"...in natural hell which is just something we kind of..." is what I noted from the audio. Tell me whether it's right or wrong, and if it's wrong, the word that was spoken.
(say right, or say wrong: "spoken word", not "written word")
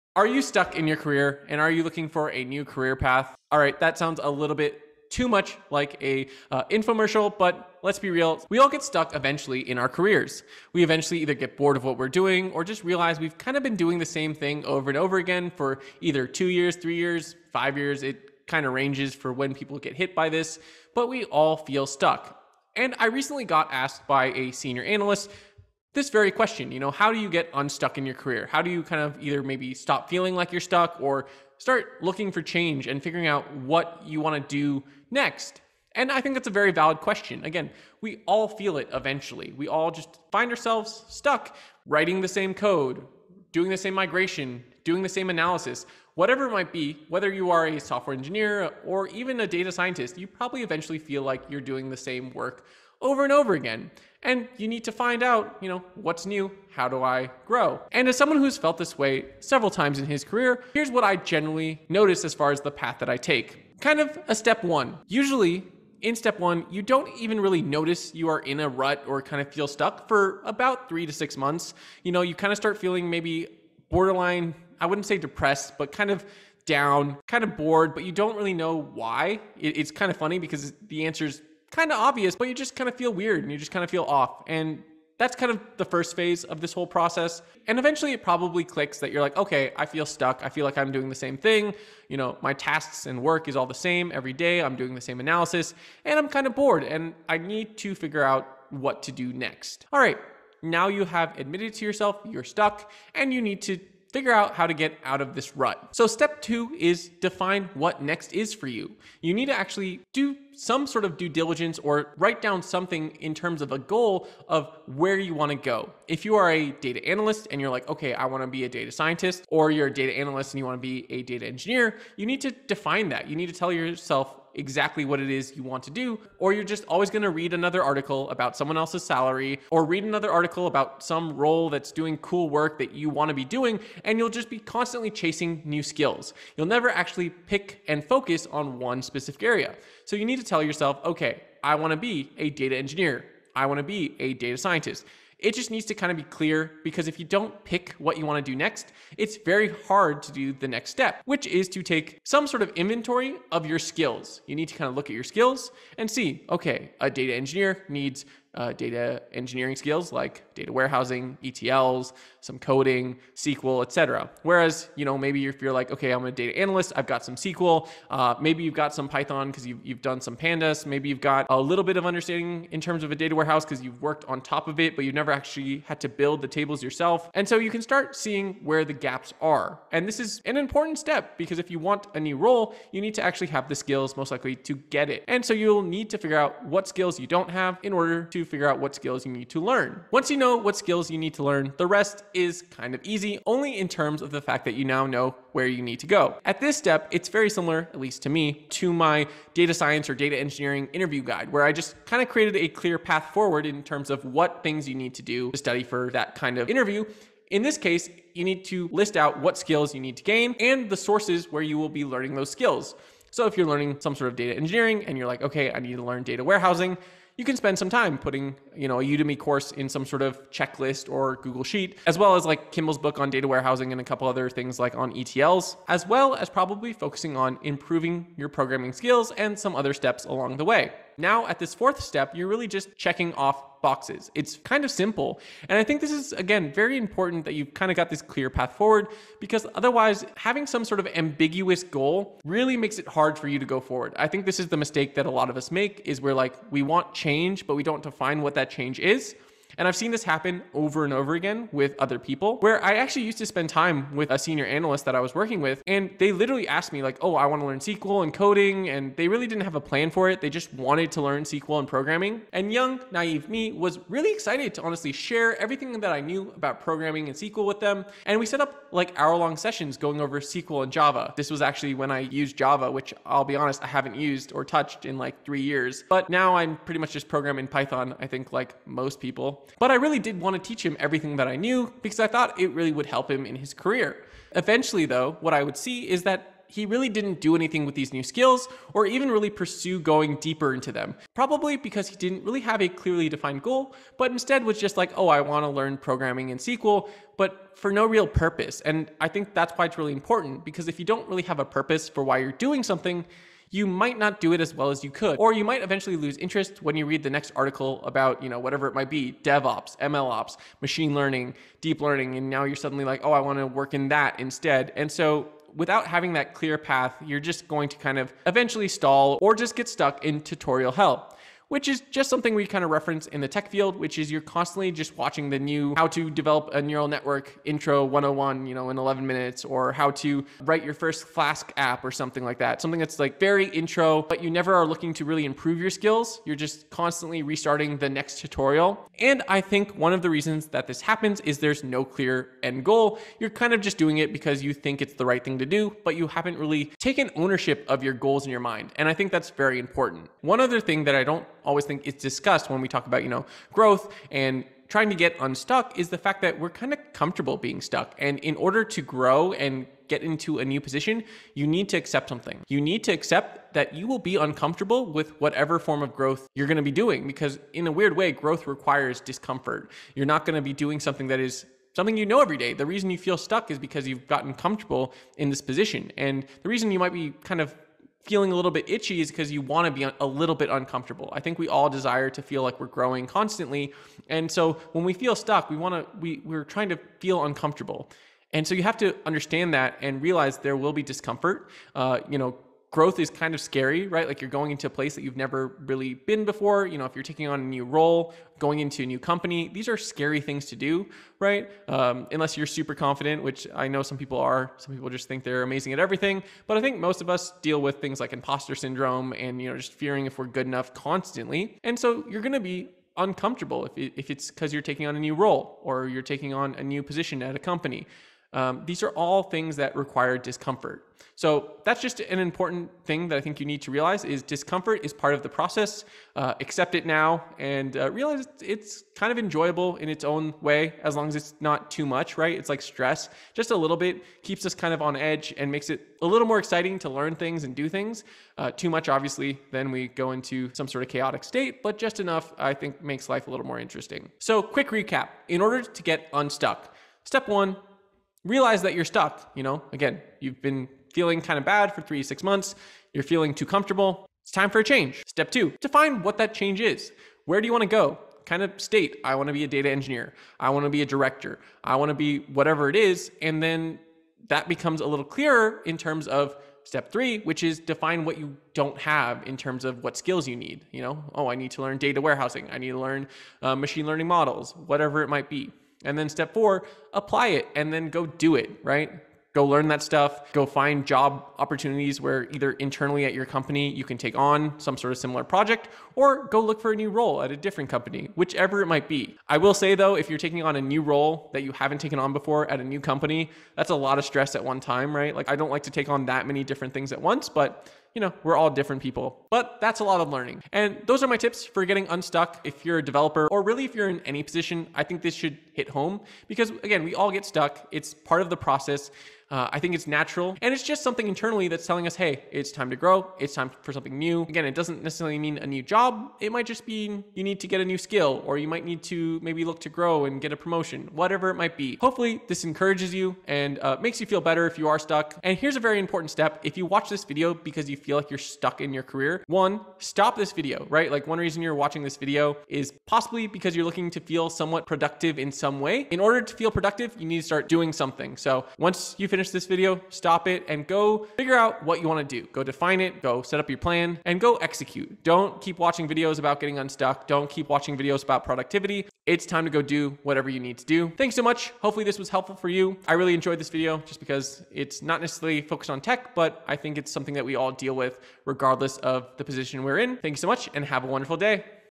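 wrong: "tutorial", not "natural".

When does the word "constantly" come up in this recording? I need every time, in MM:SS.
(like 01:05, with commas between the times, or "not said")
02:14, 05:24, 05:36, 06:23, 06:50.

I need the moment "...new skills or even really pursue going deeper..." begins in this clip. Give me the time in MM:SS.
04:48.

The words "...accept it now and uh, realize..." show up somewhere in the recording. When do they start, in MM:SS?
07:06.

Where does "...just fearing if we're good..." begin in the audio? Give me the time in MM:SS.
06:49.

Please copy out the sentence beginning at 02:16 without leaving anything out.
You'll never actually pick and focus on one specific area.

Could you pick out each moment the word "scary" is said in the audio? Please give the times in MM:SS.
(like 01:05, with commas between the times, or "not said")
06:33, 06:39.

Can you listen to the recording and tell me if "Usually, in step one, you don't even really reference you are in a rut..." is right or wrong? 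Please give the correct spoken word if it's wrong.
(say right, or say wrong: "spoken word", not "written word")
wrong: "notice", not "reference".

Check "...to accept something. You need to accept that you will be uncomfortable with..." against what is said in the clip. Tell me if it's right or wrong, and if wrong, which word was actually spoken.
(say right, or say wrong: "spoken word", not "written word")
right.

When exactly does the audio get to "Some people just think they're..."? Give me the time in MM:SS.
06:44.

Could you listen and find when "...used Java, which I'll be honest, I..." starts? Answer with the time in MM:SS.
04:32.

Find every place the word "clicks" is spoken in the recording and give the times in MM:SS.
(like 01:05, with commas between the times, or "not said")
01:28.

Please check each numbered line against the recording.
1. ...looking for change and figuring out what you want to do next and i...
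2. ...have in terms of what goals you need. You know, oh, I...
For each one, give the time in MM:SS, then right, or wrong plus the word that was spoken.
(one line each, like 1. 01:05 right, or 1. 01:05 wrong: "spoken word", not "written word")
1. 00:32 right
2. 07:48 wrong: "skills", not "goals".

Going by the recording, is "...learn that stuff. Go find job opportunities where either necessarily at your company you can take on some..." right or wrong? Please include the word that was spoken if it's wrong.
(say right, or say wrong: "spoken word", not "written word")
wrong: "internally", not "necessarily".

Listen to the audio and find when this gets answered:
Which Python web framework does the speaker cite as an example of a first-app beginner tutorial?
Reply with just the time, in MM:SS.
05:31.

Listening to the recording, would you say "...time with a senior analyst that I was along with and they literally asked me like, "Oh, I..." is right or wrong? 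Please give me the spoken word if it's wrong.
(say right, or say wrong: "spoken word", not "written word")
wrong: "working", not "along".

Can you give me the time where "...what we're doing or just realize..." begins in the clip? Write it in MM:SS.
00:11.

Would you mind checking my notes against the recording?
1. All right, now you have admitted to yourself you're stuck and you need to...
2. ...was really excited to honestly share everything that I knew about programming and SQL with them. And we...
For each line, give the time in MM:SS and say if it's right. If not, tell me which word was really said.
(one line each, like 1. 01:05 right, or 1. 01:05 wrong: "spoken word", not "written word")
1. 01:39 right
2. 04:23 right.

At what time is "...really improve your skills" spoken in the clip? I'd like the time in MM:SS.
05:35.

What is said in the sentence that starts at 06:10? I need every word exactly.
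You're not going to be doing something that is something you know every day.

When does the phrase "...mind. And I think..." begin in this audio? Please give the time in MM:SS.
05:48.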